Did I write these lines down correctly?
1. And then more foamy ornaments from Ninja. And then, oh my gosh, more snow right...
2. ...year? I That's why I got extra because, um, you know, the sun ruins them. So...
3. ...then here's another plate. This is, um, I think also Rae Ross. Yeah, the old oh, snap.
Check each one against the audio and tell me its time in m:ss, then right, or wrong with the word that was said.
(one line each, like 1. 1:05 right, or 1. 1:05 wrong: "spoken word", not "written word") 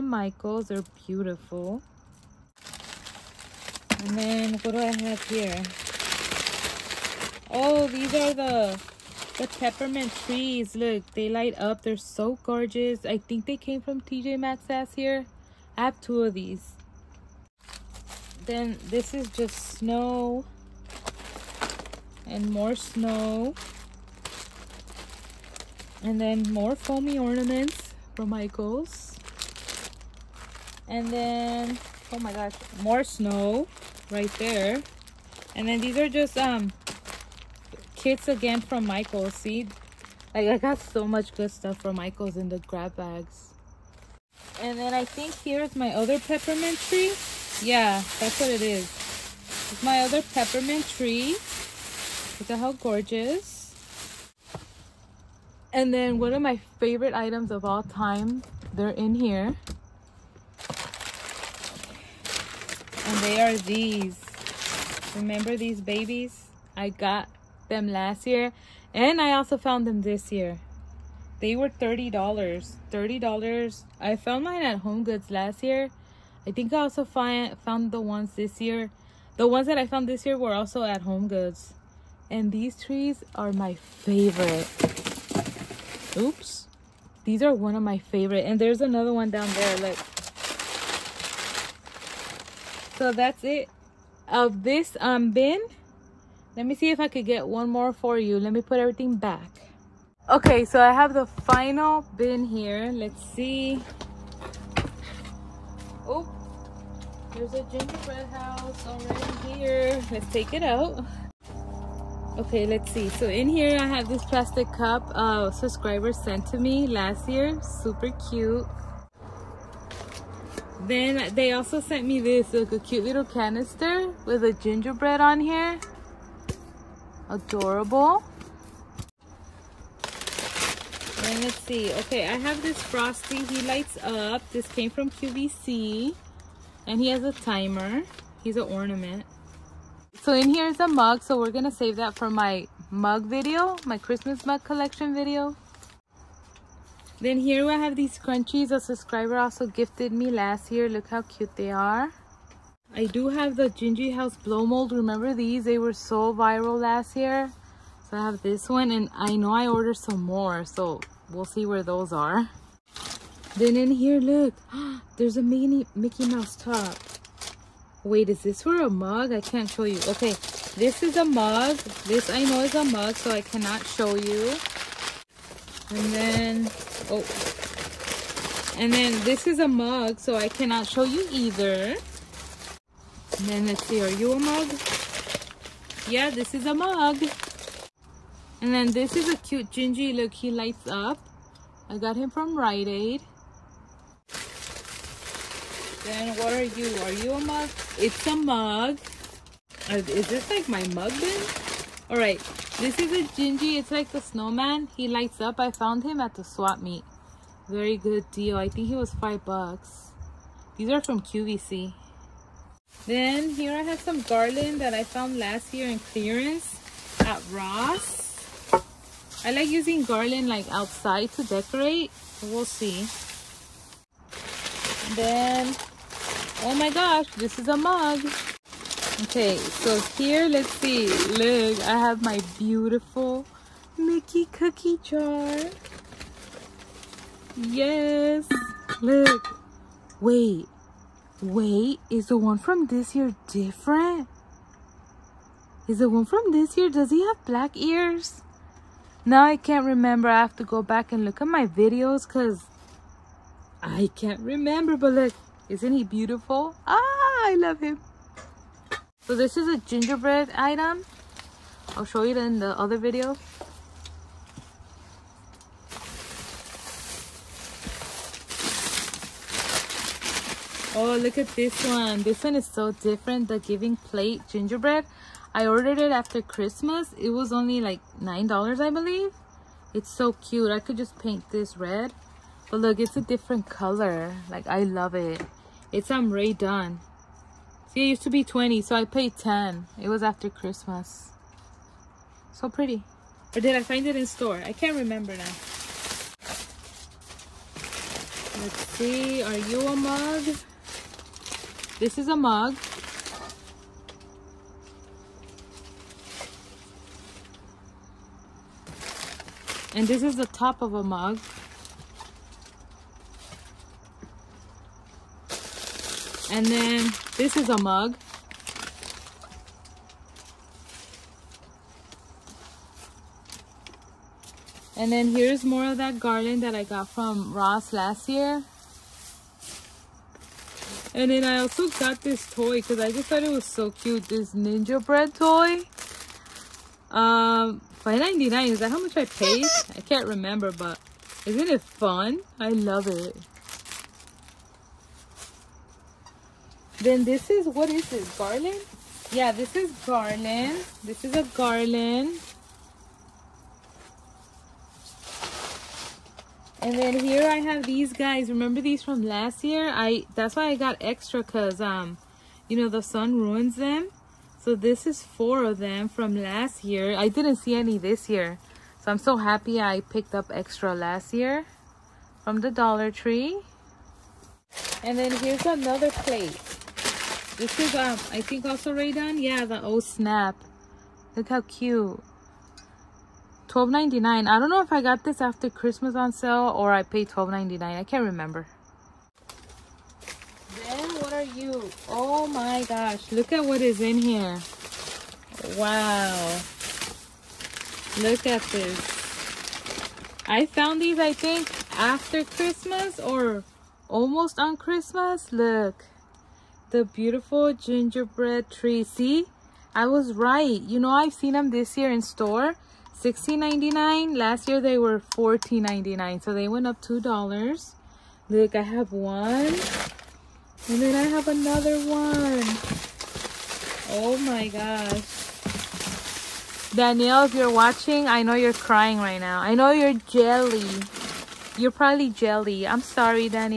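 1. 0:26 wrong: "Michaels", not "Ninja"
2. 5:59 right
3. 6:15 wrong: "Dunn", not "Ross".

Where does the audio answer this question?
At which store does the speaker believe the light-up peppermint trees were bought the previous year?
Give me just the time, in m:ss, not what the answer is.
0:14.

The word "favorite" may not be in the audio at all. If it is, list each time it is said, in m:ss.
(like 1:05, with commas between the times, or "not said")
0:56, 1:23, 1:27.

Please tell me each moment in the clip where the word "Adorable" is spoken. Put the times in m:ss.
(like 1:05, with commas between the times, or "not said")
2:07.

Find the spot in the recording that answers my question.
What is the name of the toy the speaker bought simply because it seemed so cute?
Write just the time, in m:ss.
5:34.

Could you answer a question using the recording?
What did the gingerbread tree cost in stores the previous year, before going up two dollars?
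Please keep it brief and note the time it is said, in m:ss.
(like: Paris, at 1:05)
$14.99, at 6:55.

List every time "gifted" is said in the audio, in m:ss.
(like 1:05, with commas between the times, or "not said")
2:29.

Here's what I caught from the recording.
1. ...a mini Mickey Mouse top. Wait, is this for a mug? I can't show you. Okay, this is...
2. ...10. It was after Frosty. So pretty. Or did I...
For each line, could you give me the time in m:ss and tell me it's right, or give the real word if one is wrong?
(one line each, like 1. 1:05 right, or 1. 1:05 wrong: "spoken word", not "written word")
1. 2:45 right
2. 4:49 wrong: "Christmas", not "Frosty".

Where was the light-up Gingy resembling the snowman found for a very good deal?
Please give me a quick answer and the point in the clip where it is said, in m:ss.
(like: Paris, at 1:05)
swap meet, at 3:26.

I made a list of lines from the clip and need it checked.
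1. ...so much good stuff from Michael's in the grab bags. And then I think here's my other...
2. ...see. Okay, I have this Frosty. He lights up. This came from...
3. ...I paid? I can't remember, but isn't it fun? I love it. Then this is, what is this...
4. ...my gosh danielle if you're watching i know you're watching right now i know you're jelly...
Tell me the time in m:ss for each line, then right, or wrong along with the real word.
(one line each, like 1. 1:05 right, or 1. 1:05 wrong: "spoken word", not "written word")
1. 0:40 right
2. 2:11 right
3. 5:39 right
4. 7:04 wrong: "crying", not "watching".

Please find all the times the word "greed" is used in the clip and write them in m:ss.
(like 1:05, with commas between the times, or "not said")
not said.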